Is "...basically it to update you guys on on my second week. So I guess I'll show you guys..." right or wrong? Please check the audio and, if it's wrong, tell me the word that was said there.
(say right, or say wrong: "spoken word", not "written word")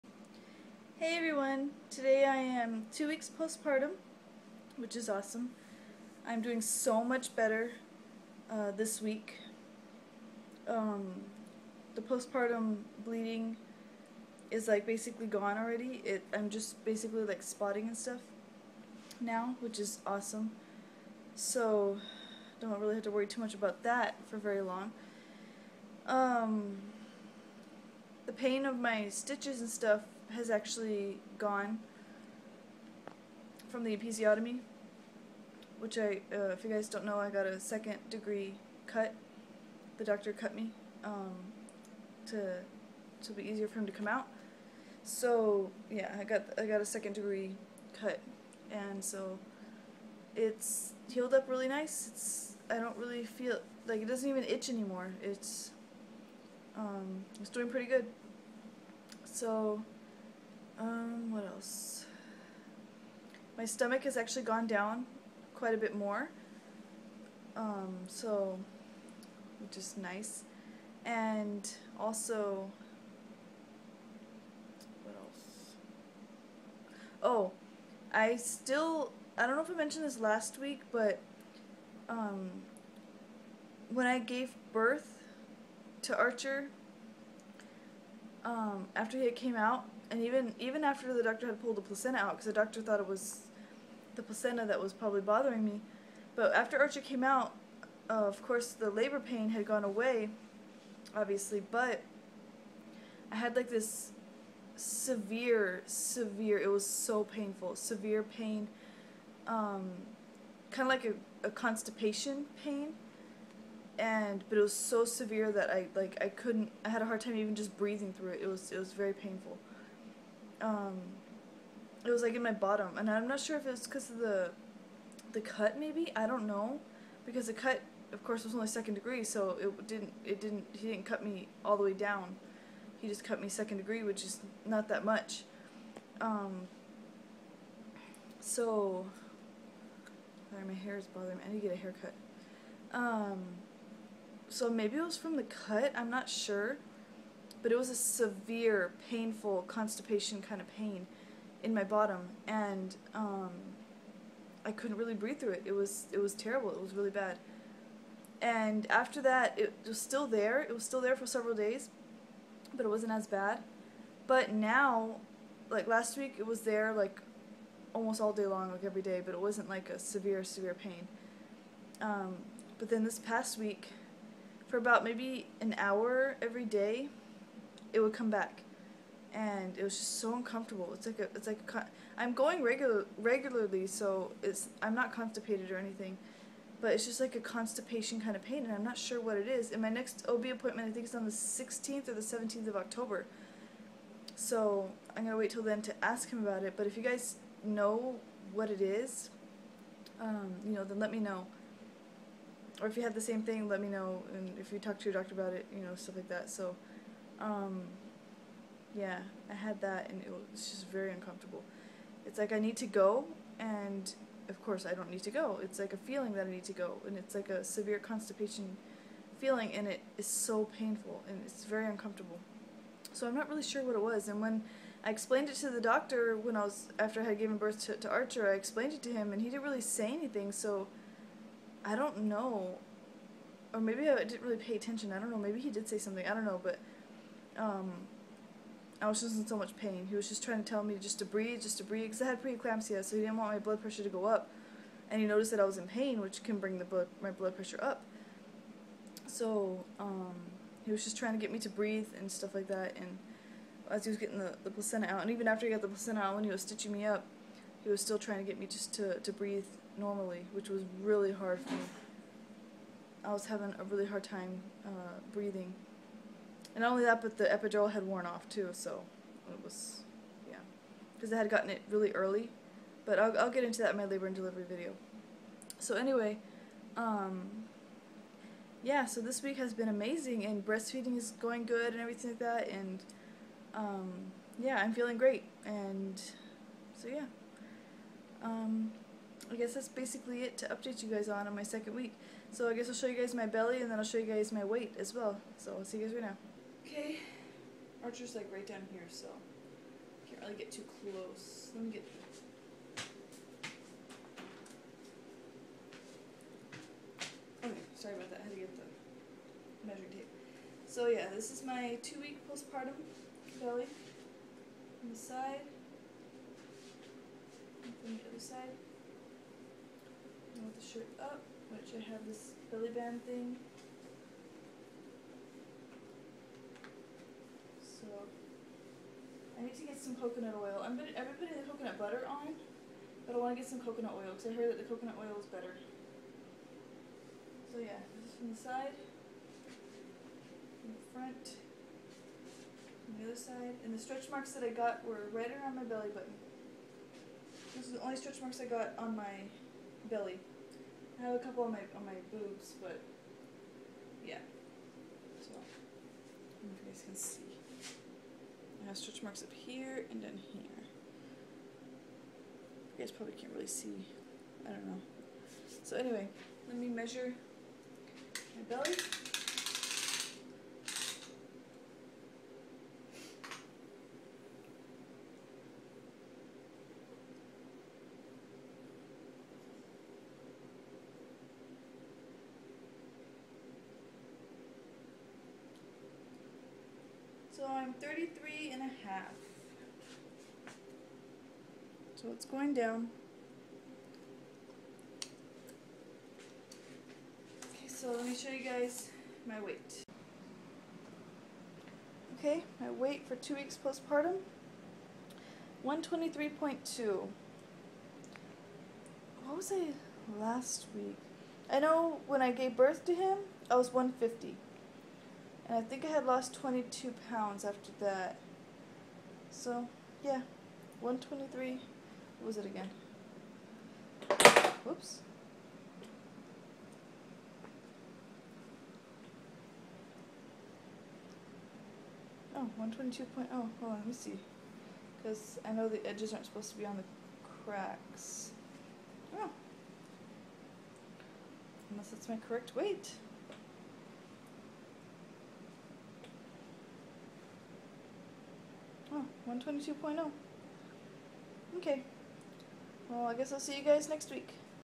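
right.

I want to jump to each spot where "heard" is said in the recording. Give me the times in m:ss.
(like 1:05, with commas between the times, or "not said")
5:34.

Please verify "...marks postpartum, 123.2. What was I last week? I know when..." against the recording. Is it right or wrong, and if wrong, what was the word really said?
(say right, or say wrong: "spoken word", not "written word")
wrong: "weeks", not "marks".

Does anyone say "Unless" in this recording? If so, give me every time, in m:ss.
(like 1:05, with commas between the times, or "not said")
7:21.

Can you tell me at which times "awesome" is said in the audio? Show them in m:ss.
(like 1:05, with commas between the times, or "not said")
0:05, 0:20.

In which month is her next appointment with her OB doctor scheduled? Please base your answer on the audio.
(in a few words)
October.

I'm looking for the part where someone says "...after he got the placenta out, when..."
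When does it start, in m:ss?
4:15.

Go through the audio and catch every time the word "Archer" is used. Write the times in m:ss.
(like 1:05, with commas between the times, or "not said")
1:26, 1:36, 3:48, 4:58.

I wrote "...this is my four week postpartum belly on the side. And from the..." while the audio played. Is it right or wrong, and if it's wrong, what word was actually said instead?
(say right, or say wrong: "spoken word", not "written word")
wrong: "two", not "four".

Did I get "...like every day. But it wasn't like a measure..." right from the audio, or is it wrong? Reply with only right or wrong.
wrong.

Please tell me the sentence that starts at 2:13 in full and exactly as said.
He just cut me second degree, which is not that much.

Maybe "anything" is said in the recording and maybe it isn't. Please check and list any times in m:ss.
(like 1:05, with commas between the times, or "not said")
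3:05, 3:50.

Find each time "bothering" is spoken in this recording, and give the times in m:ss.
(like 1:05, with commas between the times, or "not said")
1:35, 2:21.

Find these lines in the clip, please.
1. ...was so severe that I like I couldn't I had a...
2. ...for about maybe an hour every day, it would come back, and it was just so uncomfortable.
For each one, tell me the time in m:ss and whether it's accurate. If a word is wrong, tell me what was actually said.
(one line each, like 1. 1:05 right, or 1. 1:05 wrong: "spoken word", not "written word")
1. 1:54 right
2. 2:54 right.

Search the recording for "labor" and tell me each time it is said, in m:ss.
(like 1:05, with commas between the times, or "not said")
1:38, 4:34.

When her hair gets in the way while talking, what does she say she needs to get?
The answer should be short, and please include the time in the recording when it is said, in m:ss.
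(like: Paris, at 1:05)
a haircut, at 2:21.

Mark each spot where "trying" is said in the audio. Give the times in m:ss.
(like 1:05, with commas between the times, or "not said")
4:00, 4:11, 4:18.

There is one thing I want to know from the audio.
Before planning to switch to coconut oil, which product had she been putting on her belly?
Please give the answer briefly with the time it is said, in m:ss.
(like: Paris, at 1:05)
coconut butter, at 5:31.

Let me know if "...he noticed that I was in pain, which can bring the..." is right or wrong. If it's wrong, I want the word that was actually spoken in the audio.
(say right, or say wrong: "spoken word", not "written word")
right.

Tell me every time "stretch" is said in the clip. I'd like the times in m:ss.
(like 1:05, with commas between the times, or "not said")
5:43, 5:48, 5:58.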